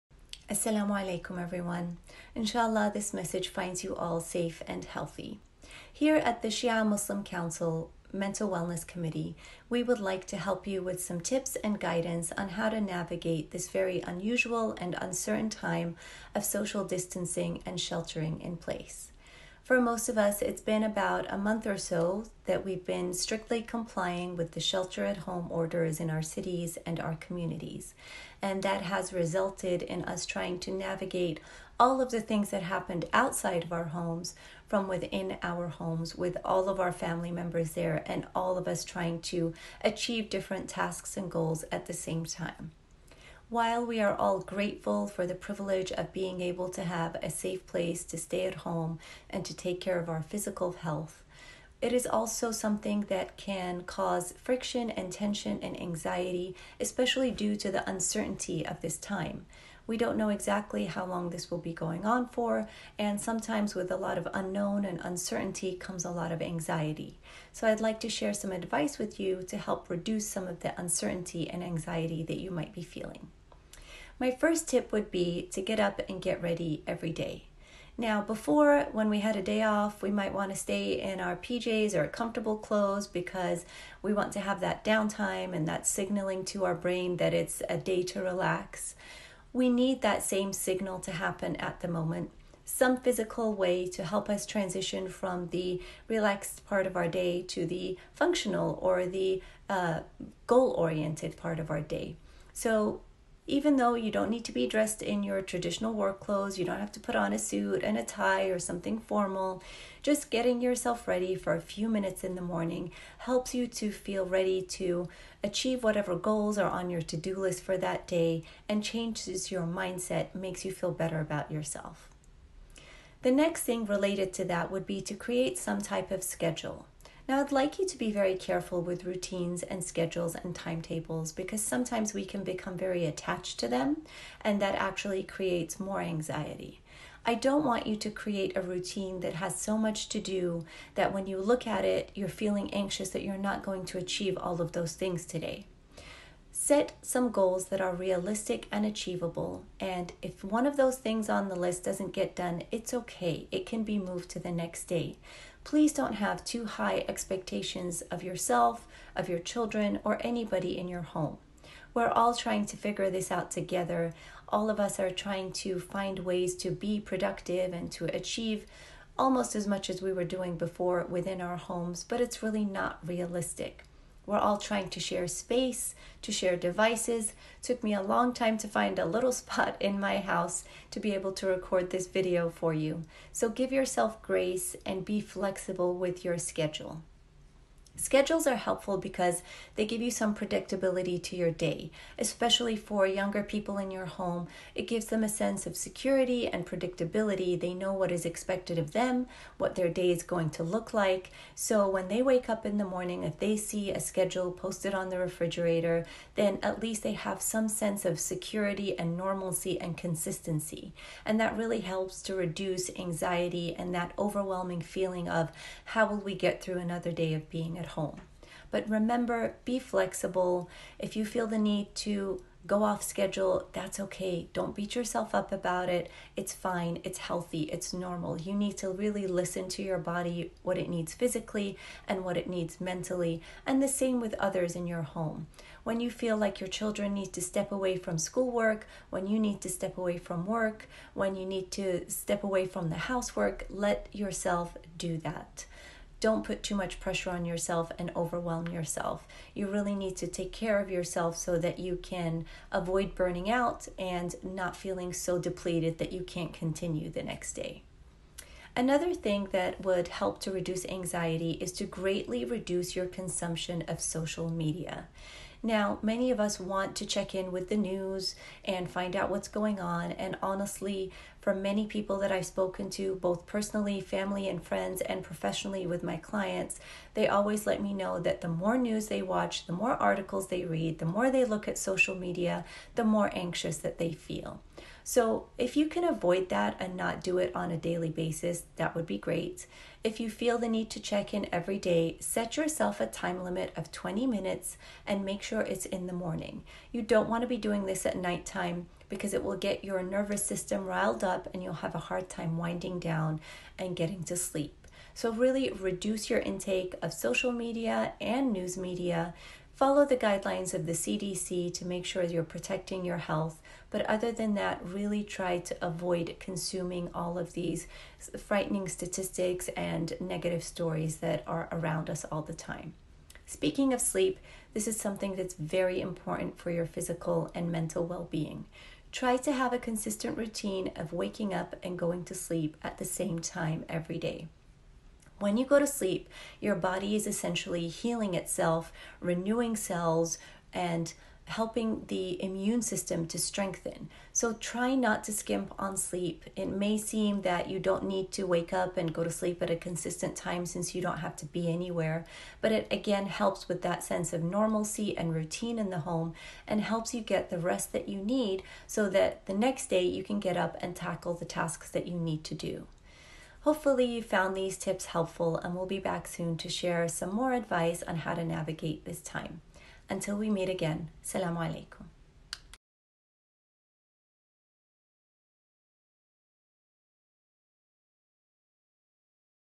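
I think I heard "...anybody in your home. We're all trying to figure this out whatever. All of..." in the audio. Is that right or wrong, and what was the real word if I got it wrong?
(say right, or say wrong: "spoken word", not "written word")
wrong: "together", not "whatever".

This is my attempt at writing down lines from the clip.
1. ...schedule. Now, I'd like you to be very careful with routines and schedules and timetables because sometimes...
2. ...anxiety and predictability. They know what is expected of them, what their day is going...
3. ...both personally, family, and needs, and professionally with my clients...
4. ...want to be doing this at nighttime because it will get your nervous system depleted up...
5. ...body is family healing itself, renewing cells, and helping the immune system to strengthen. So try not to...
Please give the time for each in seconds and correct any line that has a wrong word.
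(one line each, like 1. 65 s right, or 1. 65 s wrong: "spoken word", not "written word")
1. 126 s right
2. 195 s wrong: "security", not "anxiety"
3. 273 s wrong: "friends", not "needs"
4. 297 s wrong: "riled", not "depleted"
5. 336 s wrong: "essentially", not "family".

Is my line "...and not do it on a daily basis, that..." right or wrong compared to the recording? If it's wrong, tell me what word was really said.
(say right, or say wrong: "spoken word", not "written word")
right.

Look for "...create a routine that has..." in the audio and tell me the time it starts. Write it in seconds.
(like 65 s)
138 s.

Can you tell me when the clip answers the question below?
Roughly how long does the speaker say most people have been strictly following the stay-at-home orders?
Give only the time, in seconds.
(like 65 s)
20 s.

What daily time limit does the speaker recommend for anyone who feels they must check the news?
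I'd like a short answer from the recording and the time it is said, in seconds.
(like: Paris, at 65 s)
20 minutes, at 293 s.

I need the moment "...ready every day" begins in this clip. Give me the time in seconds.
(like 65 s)
76 s.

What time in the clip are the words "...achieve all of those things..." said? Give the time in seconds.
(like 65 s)
143 s.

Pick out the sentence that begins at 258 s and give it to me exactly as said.
Another thing that would help to reduce anxiety is to greatly reduce your consumption of social media.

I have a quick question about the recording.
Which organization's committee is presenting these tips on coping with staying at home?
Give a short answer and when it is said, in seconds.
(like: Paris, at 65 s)
Shia Muslim Council, at 6 s.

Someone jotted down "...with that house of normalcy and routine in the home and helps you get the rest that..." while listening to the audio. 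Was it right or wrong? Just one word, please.
wrong.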